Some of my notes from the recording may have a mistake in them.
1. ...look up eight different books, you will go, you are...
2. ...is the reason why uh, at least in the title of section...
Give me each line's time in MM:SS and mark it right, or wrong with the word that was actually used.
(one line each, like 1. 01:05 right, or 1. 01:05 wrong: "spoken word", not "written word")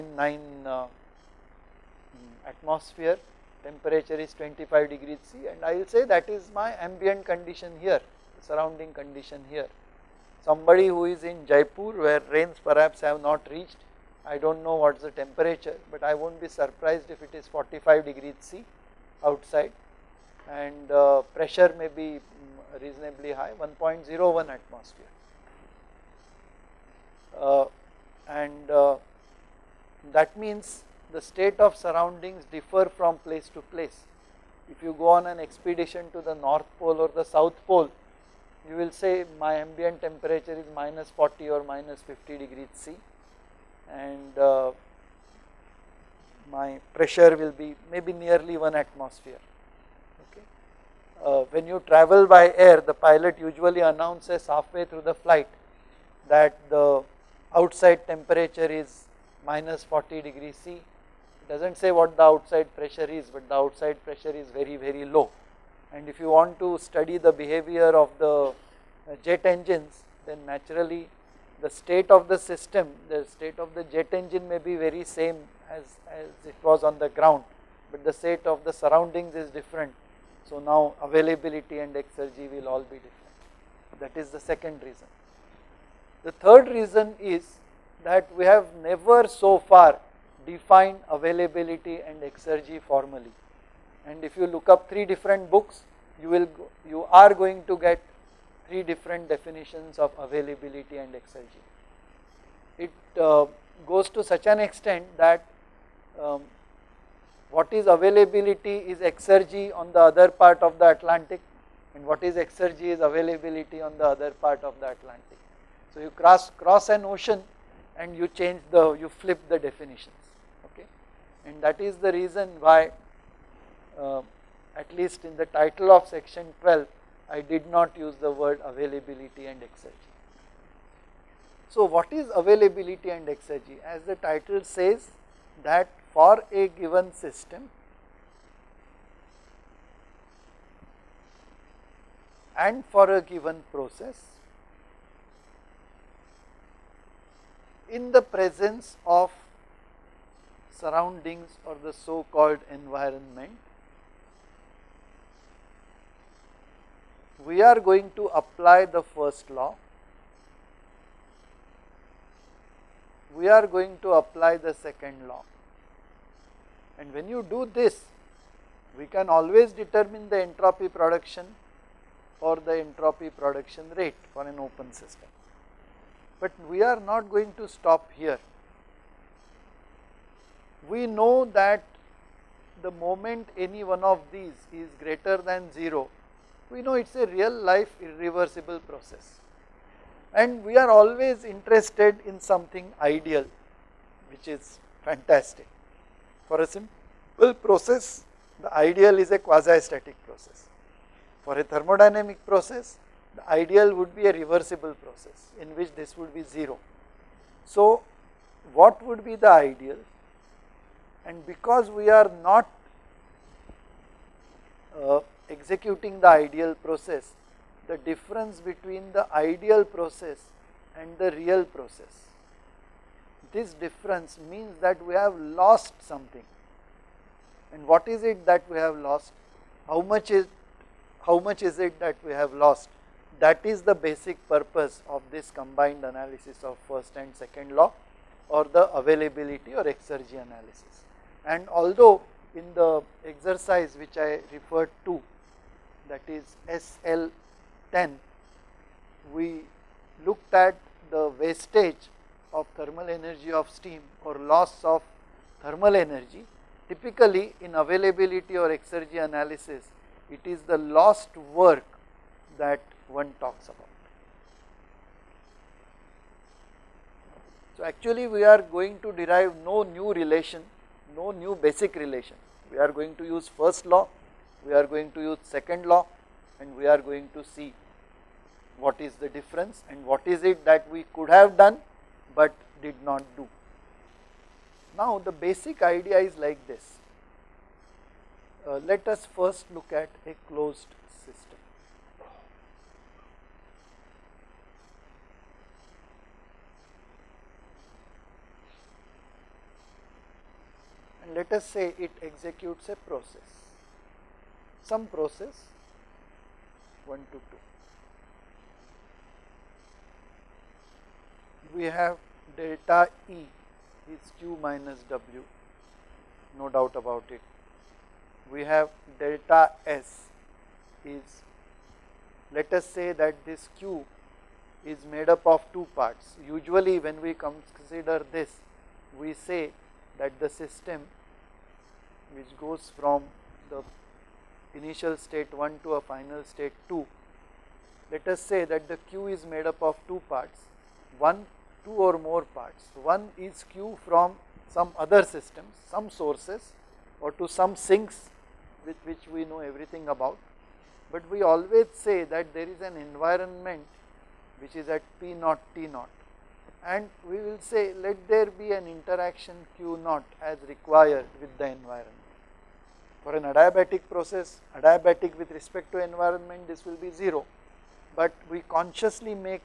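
1. 01:34 wrong: "three", not "eight"
2. 02:01 right.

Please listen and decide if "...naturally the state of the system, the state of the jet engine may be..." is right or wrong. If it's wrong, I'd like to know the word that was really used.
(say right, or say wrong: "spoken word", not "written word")
right.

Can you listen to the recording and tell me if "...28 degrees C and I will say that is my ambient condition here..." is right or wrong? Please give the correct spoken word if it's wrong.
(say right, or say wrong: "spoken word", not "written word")
wrong: "25", not "28".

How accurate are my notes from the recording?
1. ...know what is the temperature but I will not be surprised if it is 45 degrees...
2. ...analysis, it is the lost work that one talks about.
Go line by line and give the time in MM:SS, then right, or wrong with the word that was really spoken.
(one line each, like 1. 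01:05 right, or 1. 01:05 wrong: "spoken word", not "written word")
1. 00:14 right
2. 04:19 right.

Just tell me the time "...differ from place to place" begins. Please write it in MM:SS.
00:32.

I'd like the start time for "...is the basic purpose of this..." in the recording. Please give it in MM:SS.
03:53.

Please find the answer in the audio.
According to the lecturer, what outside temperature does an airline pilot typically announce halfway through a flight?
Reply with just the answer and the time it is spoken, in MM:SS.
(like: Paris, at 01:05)
minus 40 degrees C, at 00:59.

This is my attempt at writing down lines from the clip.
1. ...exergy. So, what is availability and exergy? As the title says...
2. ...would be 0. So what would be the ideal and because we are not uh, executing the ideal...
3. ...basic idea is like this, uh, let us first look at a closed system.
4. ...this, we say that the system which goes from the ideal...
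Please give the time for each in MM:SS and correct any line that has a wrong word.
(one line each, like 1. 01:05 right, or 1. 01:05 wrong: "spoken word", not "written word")
1. 02:09 right
2. 03:26 right
3. 04:45 right
4. 05:28 wrong: "initial", not "ideal".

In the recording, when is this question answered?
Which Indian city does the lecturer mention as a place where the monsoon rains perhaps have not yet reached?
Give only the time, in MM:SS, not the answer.
00:11.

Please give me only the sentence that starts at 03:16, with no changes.
For a simple process the ideal is a quasi static process.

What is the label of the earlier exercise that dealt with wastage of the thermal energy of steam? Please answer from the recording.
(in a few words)
SL10.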